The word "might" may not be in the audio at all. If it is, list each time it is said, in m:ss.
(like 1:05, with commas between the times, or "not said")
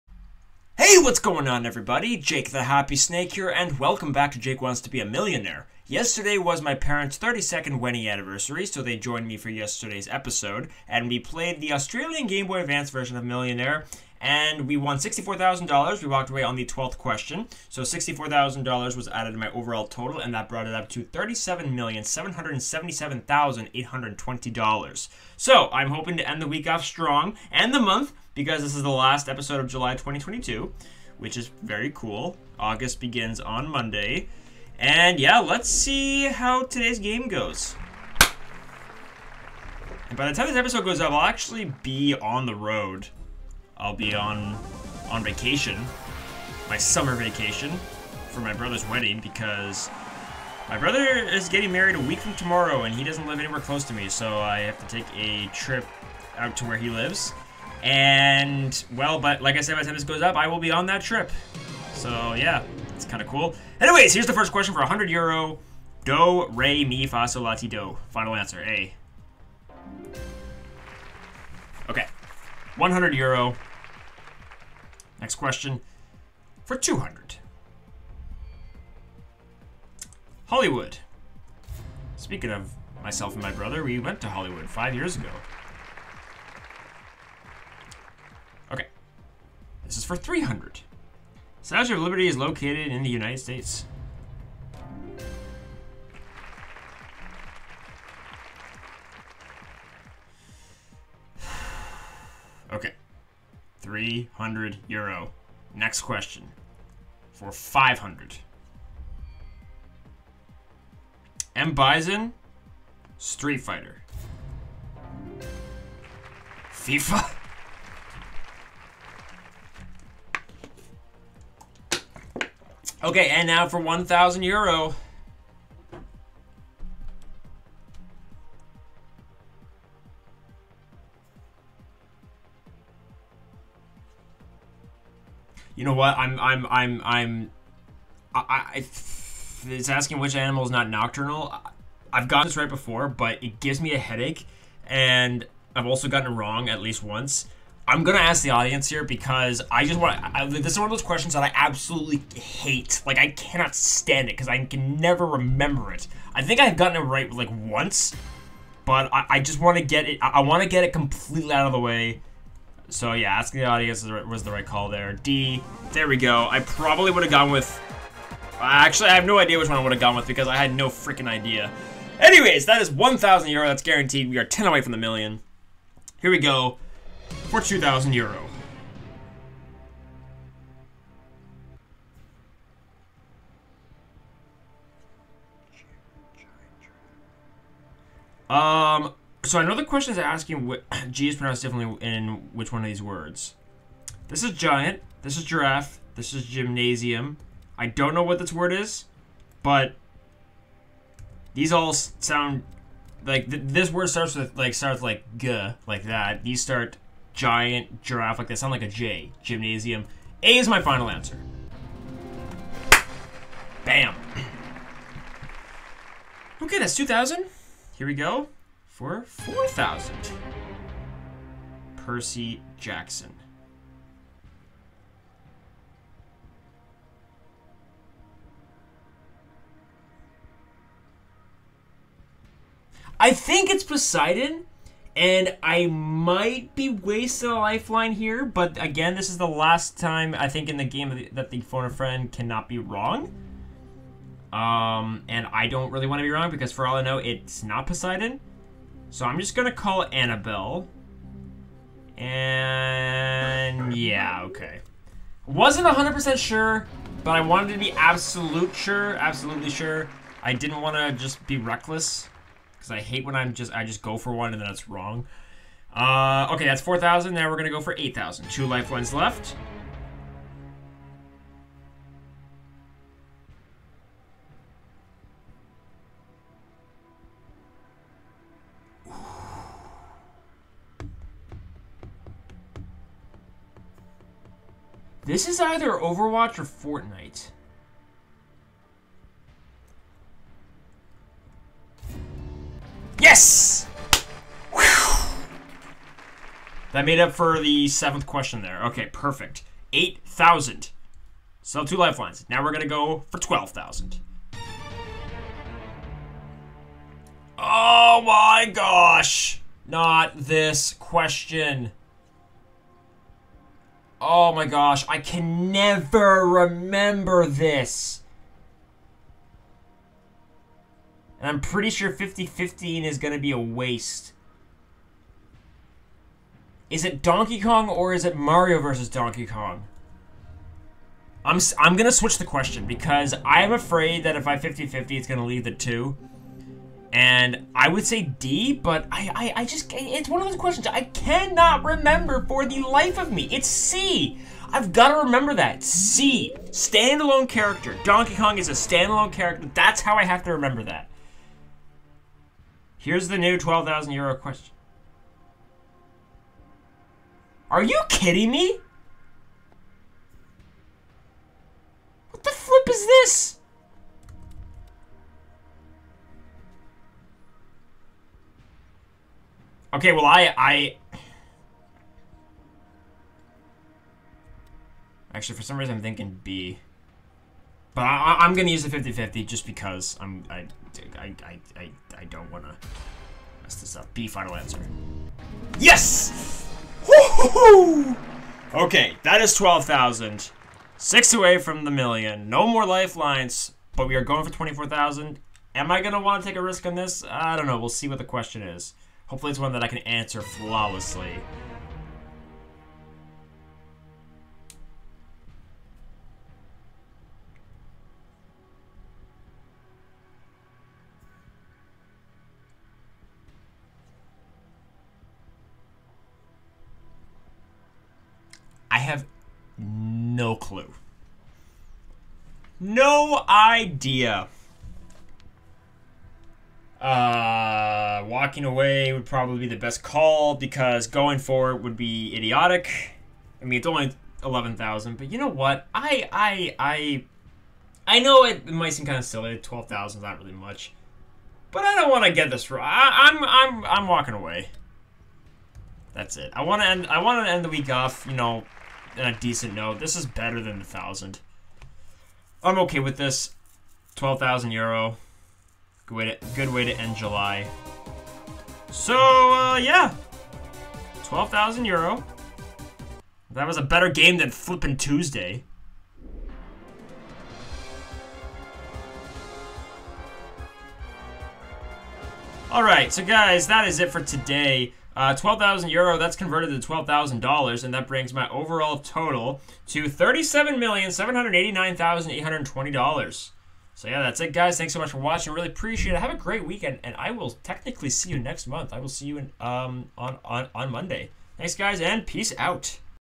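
3:55, 7:18.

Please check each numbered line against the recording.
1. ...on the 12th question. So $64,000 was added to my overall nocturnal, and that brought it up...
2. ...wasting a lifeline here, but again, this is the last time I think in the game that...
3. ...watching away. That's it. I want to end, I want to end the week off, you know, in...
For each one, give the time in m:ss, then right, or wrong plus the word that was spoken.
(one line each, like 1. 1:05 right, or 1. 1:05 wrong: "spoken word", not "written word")
1. 0:16 wrong: "total", not "nocturnal"
2. 3:56 right
3. 7:24 wrong: "walking", not "watching".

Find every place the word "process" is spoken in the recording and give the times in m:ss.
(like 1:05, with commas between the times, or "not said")
not said.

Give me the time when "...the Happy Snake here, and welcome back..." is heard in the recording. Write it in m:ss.
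0:02.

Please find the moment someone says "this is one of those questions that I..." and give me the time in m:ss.
2:30.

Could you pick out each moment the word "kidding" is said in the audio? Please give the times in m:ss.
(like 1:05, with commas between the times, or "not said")
5:58.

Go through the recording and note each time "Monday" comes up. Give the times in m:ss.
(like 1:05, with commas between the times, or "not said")
0:33, 8:10.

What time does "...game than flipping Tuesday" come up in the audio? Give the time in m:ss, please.
7:44.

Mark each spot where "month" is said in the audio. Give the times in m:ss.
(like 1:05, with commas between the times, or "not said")
0:27, 8:08.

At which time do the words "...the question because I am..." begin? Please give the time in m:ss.
5:32.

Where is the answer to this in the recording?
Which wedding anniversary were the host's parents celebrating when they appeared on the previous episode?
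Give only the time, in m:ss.
0:07.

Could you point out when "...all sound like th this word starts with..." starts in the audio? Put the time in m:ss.
3:21.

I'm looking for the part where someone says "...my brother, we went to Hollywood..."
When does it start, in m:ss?
1:23.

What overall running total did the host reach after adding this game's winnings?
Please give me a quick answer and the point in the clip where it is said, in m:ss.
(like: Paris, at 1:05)
$37,789,820, at 8:00.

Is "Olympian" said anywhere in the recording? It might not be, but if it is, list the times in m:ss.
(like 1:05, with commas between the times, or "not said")
not said.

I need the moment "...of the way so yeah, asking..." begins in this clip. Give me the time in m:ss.
2:41.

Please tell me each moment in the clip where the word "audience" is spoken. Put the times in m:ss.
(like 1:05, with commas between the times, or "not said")
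2:28, 2:43.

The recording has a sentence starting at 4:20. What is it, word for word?
I didn't want to just be reckless because I hate when I'm just I just go for one and then it's wrong.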